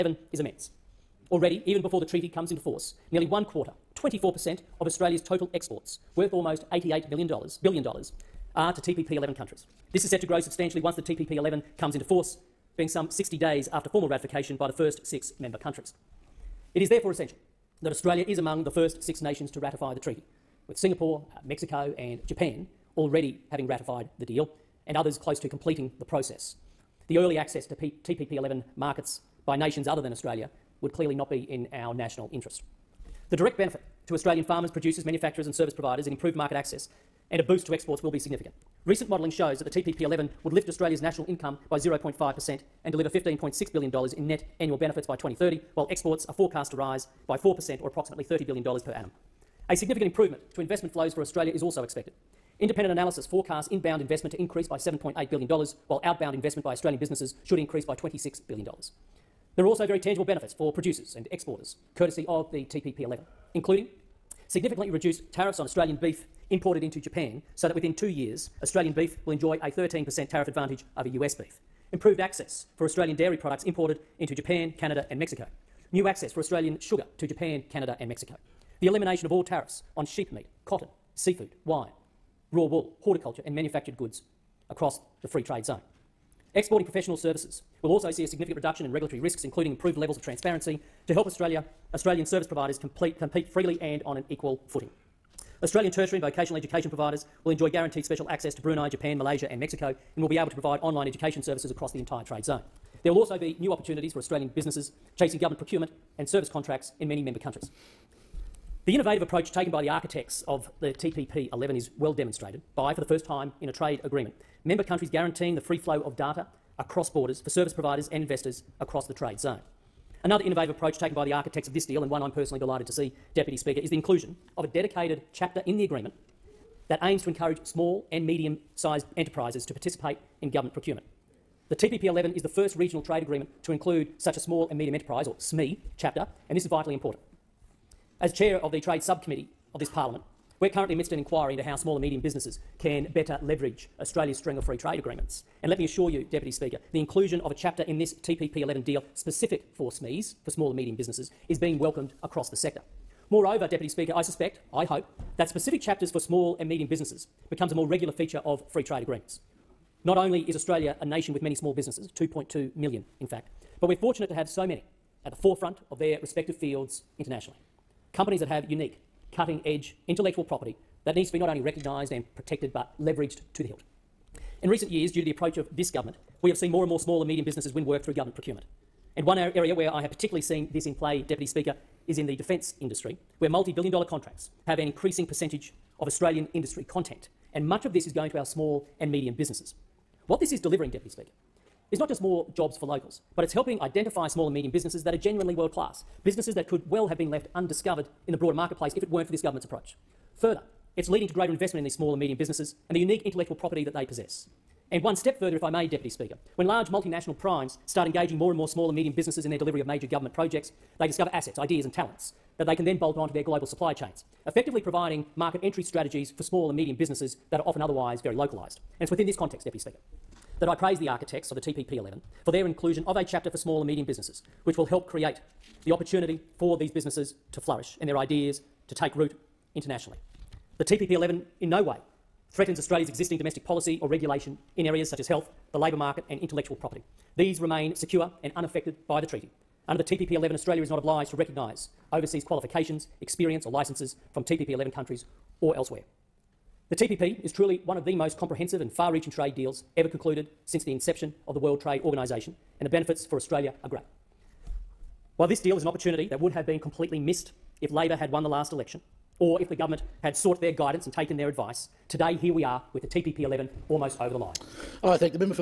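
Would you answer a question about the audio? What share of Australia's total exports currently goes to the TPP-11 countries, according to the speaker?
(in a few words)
24%.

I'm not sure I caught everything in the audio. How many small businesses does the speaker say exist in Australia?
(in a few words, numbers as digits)
2.2 million.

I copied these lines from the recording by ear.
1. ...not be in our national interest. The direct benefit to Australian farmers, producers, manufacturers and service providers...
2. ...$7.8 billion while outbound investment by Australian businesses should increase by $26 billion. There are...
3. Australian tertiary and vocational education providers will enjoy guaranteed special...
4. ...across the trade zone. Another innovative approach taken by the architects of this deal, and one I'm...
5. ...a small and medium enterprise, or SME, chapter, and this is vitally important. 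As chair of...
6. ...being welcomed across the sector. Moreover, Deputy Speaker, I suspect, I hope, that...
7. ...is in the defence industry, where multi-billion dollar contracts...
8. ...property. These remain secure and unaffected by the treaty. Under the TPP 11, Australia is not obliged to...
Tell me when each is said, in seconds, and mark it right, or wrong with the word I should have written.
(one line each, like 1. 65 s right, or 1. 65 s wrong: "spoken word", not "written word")
1. 31 s right
2. 54 s right
3. 95 s right
4. 118 s right
5. 134 s right
6. 151 s right
7. 182 s right
8. 236 s right.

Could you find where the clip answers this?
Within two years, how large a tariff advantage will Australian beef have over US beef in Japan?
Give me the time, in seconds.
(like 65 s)
69 s.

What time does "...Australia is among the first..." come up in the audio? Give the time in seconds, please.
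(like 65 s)
17 s.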